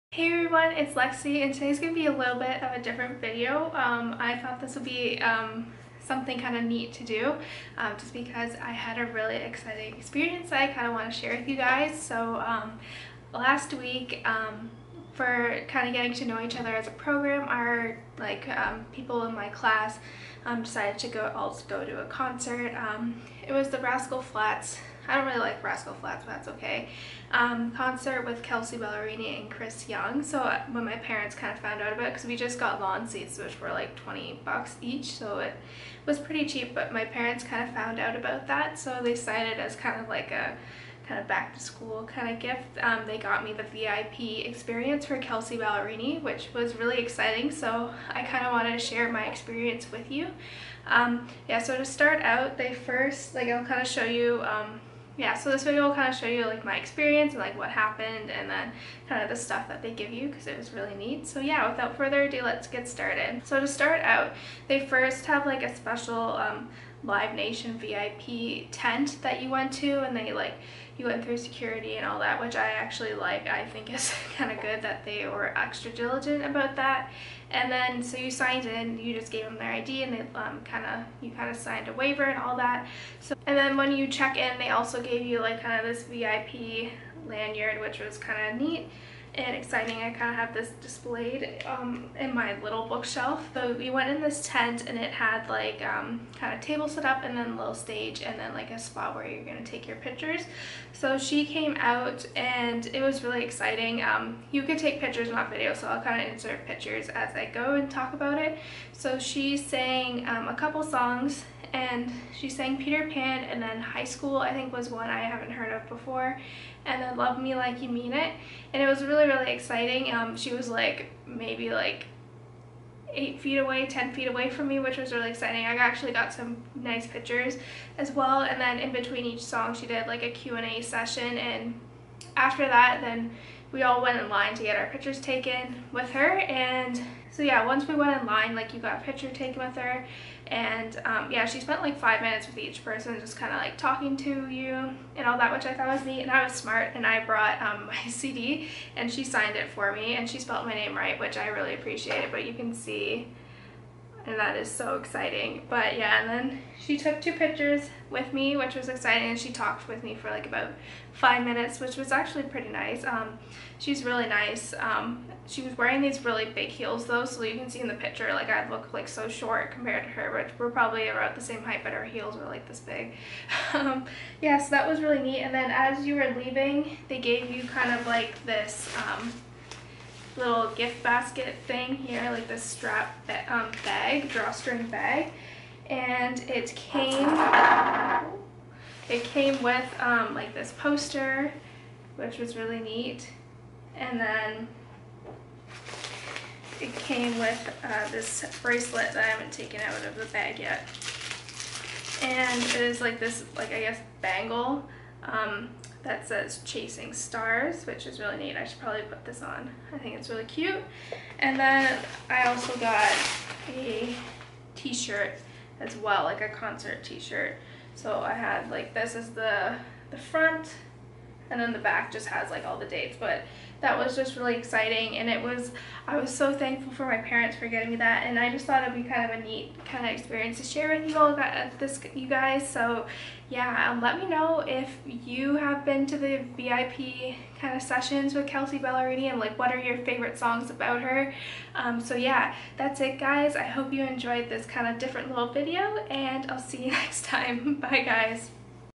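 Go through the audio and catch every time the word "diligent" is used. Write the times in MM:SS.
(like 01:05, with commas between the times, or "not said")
01:15.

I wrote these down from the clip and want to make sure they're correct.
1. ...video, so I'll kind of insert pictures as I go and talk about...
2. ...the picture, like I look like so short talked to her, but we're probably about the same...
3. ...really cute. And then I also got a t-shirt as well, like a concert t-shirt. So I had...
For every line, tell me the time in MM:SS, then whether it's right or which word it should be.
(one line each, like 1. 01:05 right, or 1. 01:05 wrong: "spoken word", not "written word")
1. 01:45 right
2. 02:47 wrong: "compared", not "talked"
3. 03:30 right.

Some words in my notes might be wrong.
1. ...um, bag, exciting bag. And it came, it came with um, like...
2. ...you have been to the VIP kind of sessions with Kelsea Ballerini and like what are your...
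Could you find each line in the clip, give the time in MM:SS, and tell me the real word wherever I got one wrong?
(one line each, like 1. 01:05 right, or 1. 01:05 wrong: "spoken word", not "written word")
1. 03:03 wrong: "drawstring", not "exciting"
2. 03:55 right.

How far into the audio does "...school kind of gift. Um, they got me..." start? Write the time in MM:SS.
00:41.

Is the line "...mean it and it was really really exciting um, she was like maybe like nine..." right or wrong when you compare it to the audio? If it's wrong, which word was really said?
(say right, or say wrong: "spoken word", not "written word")
wrong: "eight", not "nine".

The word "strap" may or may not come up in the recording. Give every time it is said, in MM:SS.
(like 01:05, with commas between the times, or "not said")
03:02.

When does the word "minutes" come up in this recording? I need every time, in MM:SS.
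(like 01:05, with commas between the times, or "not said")
02:22, 02:41.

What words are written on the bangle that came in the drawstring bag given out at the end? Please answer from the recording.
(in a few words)
Chasing Stars.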